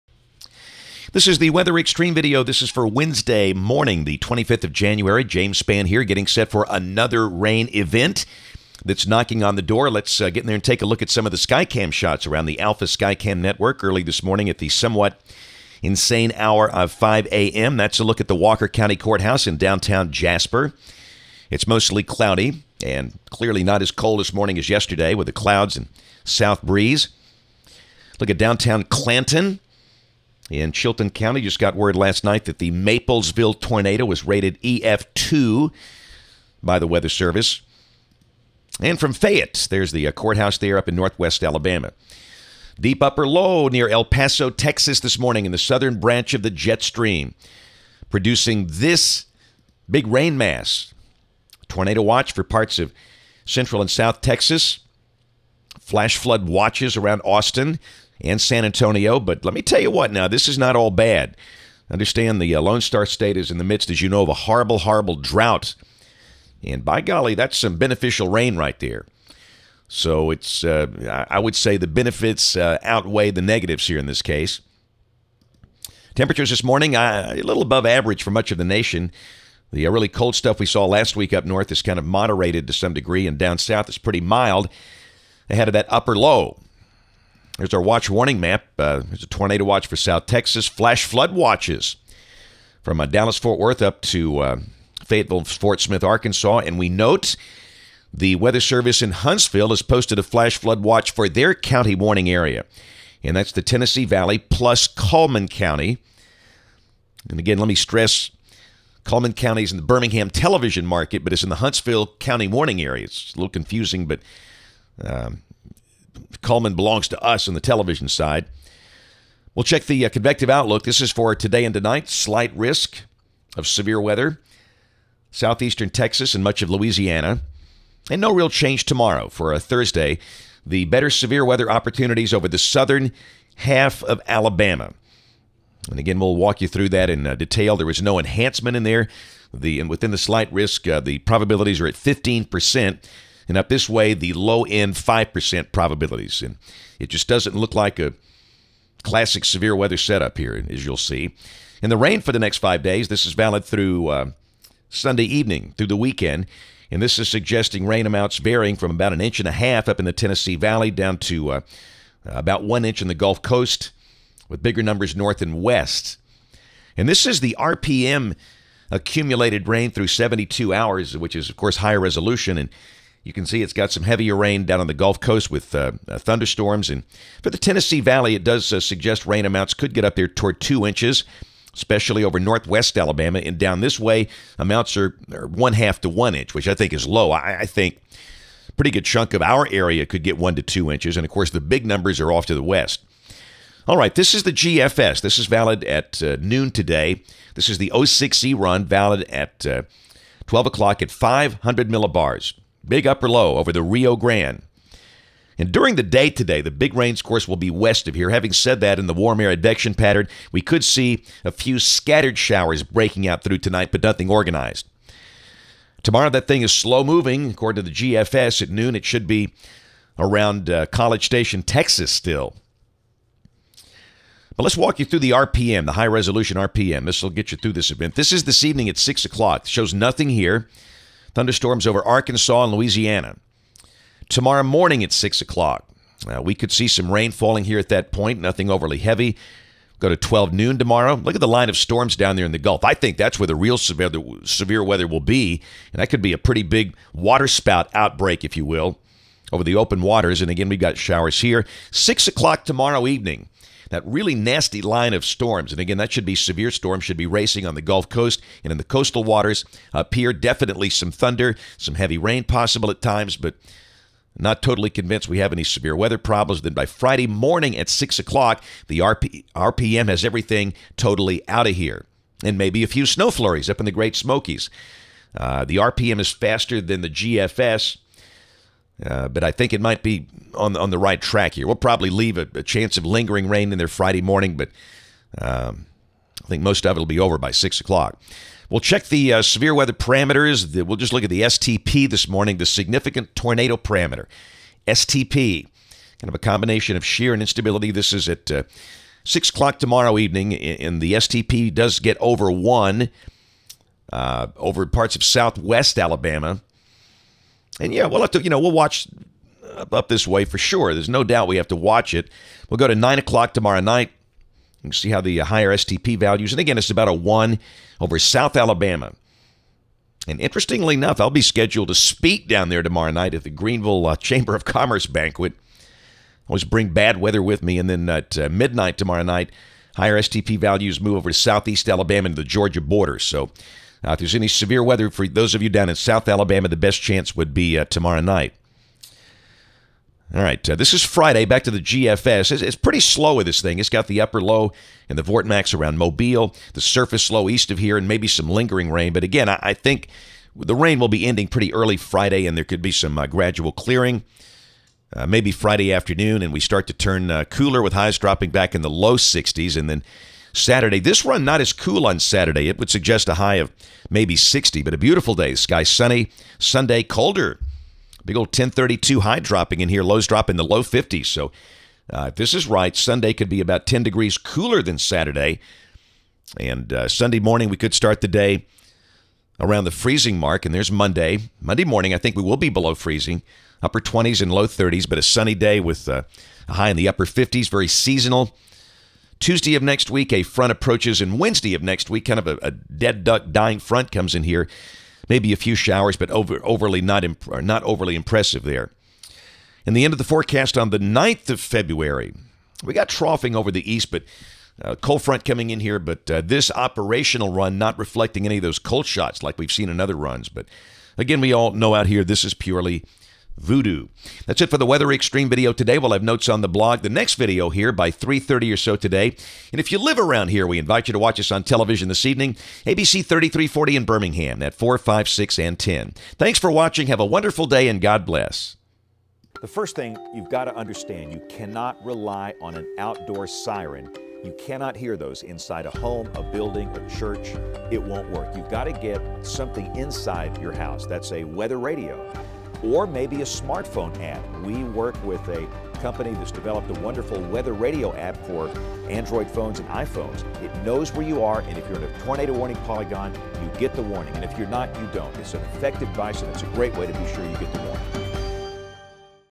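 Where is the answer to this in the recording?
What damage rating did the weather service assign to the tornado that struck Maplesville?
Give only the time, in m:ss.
0:34.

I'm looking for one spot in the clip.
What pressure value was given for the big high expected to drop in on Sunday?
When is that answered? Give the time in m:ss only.
6:08.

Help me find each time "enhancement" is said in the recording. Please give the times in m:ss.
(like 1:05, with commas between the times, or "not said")
2:18.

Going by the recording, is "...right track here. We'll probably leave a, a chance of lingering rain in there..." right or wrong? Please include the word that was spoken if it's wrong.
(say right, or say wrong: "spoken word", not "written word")
right.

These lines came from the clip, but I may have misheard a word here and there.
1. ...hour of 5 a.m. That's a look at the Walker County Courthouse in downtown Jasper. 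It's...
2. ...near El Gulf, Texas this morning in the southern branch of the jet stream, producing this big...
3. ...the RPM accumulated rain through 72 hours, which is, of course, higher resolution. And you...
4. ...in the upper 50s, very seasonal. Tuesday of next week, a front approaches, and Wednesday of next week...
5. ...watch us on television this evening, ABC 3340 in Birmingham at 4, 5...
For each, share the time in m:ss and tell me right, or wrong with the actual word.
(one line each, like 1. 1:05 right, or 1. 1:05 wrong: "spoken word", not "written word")
1. 0:16 right
2. 0:43 wrong: "Paso", not "Gulf"
3. 2:47 right
4. 6:26 right
5. 7:01 right.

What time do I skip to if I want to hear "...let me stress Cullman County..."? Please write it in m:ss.
1:47.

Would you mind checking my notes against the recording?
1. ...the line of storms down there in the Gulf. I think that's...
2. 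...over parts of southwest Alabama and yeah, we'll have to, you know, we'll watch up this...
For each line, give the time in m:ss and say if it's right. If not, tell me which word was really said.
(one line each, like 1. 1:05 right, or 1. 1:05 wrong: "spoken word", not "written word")
1. 4:01 right
2. 5:04 right.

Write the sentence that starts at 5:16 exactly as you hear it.
And again, it's about a 1 over South Alabama.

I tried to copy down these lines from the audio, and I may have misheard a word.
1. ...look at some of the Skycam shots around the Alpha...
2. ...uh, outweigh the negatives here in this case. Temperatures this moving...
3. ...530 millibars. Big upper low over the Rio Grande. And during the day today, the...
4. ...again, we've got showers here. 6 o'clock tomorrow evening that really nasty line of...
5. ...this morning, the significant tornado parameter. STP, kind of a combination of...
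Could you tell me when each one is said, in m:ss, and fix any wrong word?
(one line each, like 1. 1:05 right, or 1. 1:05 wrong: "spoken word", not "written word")
1. 0:10 right
2. 1:12 wrong: "morning", not "moving"
3. 3:21 wrong: "500", not "530"
4. 4:10 right
5. 4:52 right.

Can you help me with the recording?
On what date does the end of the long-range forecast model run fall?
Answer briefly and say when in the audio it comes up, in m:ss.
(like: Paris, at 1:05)
9th of February, at 6:40.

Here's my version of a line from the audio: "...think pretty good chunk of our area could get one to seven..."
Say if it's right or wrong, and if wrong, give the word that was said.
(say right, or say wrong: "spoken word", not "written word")
wrong: "two", not "seven".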